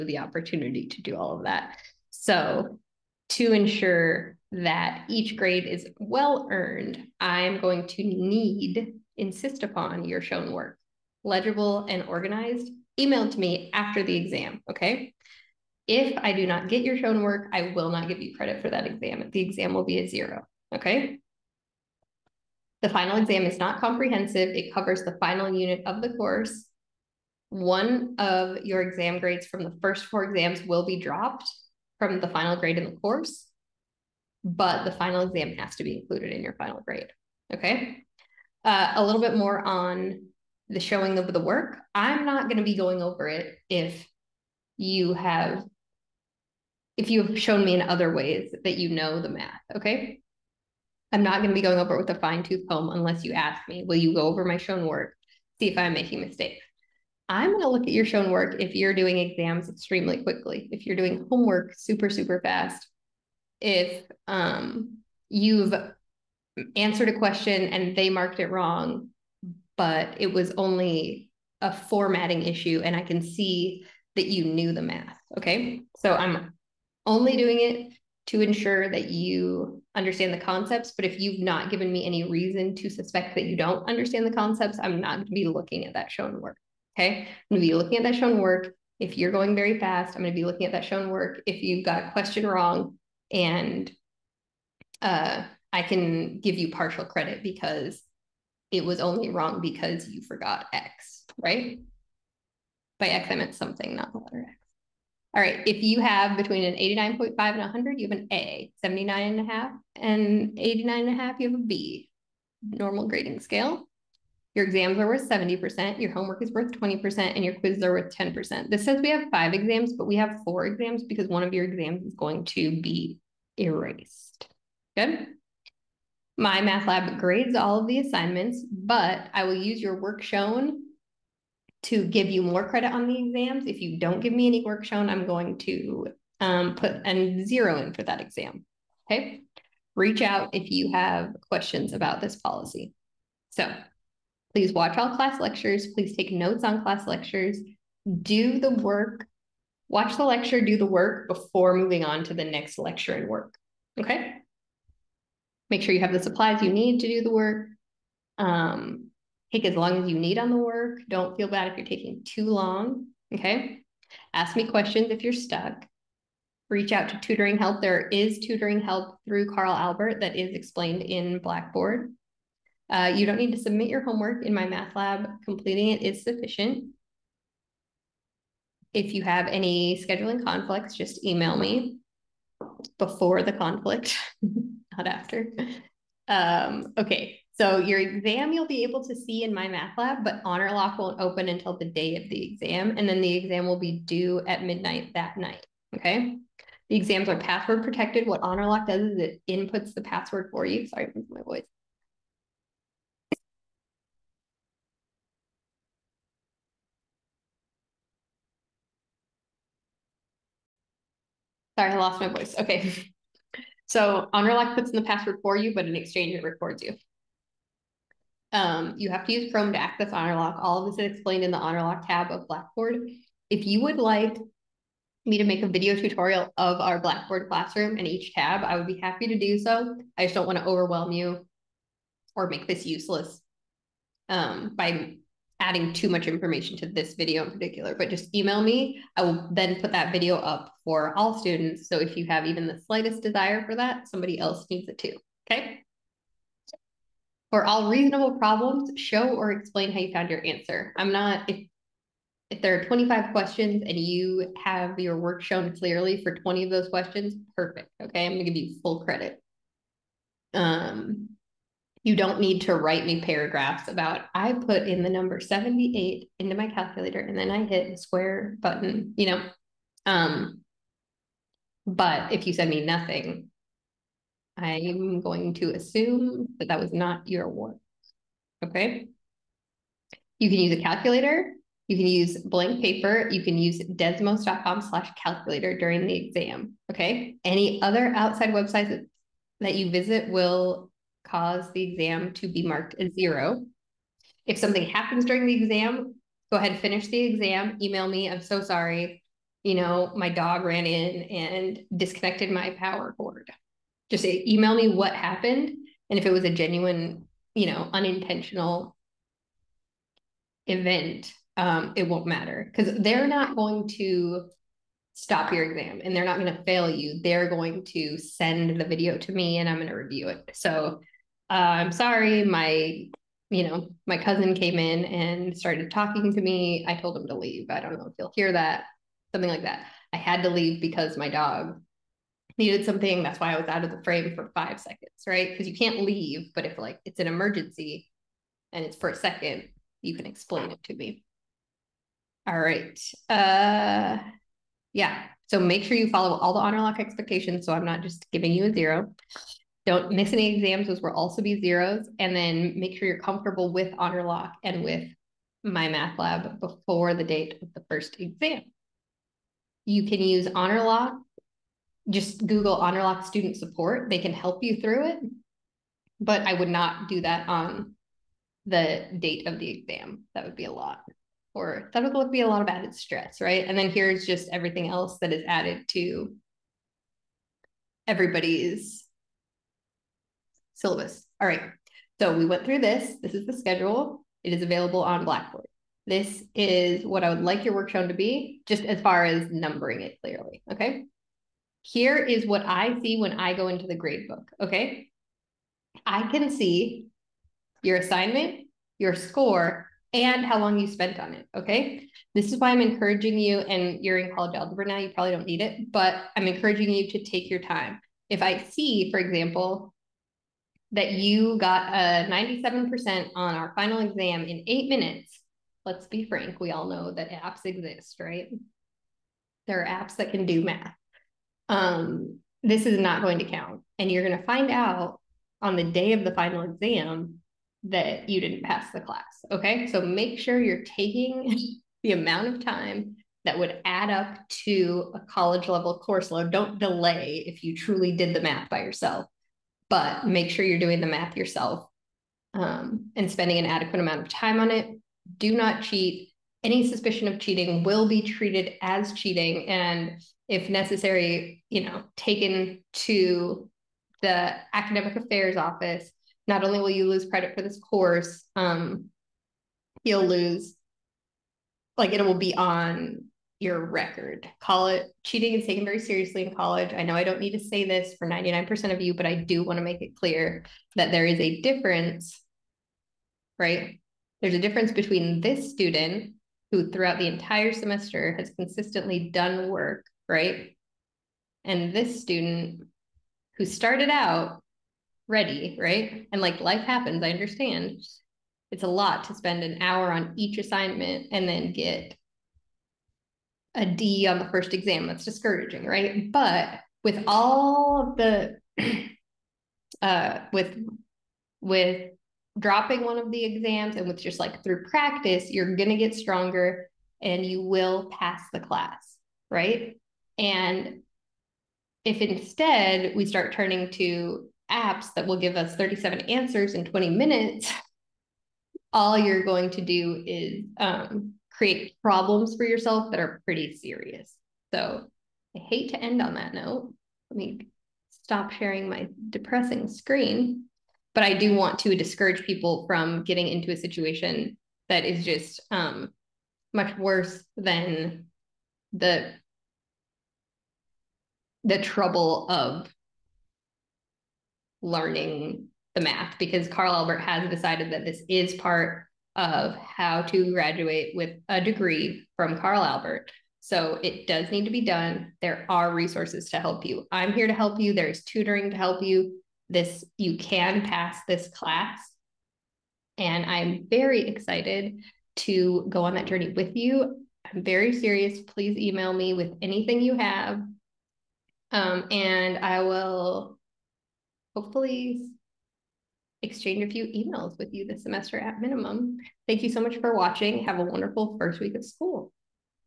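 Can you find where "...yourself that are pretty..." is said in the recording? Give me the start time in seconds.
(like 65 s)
522 s.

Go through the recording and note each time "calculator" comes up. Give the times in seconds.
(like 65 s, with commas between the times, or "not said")
266 s, 280 s, 285 s.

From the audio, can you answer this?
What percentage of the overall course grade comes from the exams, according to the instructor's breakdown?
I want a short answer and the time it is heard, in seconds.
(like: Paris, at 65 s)
70%, at 115 s.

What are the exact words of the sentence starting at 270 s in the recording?
Um, but if you send me nothing, I'm going to assume that that was not your work.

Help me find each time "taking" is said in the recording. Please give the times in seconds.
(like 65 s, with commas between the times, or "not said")
161 s, 430 s.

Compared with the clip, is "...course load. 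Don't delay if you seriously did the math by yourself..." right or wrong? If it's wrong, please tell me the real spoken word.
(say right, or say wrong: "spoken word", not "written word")
wrong: "truly", not "seriously".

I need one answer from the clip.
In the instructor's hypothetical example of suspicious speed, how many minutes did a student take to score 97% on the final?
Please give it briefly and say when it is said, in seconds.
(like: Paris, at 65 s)
8, at 414 s.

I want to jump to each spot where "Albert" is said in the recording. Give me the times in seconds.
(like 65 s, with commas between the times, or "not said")
169 s, 546 s, 552 s.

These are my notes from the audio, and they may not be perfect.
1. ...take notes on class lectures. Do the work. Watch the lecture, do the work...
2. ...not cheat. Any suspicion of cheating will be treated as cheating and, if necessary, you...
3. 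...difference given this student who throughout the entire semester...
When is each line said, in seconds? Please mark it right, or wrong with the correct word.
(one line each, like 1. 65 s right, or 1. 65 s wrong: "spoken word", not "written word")
1. 146 s right
2. 445 s right
3. 474 s wrong: "between", not "given".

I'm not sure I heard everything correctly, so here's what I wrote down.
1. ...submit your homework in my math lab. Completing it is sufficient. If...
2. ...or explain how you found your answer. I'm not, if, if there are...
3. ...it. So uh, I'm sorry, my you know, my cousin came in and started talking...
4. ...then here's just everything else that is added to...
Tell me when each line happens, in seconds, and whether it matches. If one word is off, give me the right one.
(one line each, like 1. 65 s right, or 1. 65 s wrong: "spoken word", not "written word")
1. 173 s right
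2. 249 s right
3. 320 s right
4. 373 s right.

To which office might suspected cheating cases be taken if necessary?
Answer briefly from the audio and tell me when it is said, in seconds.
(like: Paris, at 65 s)
academic affairs office, at 454 s.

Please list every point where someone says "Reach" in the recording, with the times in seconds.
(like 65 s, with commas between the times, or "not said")
139 s, 166 s.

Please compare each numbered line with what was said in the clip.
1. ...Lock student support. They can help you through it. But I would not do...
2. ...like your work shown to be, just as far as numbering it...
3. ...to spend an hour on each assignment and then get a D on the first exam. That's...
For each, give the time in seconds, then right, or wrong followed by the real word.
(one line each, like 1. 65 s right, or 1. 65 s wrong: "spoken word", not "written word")
1. 363 s right
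2. 387 s right
3. 489 s right.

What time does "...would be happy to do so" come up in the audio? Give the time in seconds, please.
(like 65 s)
228 s.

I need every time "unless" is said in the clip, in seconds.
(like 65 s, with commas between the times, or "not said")
52 s.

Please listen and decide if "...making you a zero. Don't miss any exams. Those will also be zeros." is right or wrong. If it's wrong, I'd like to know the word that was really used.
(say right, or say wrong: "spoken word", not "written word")
wrong: "giving", not "making".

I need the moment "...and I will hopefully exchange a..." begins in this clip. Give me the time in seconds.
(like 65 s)
572 s.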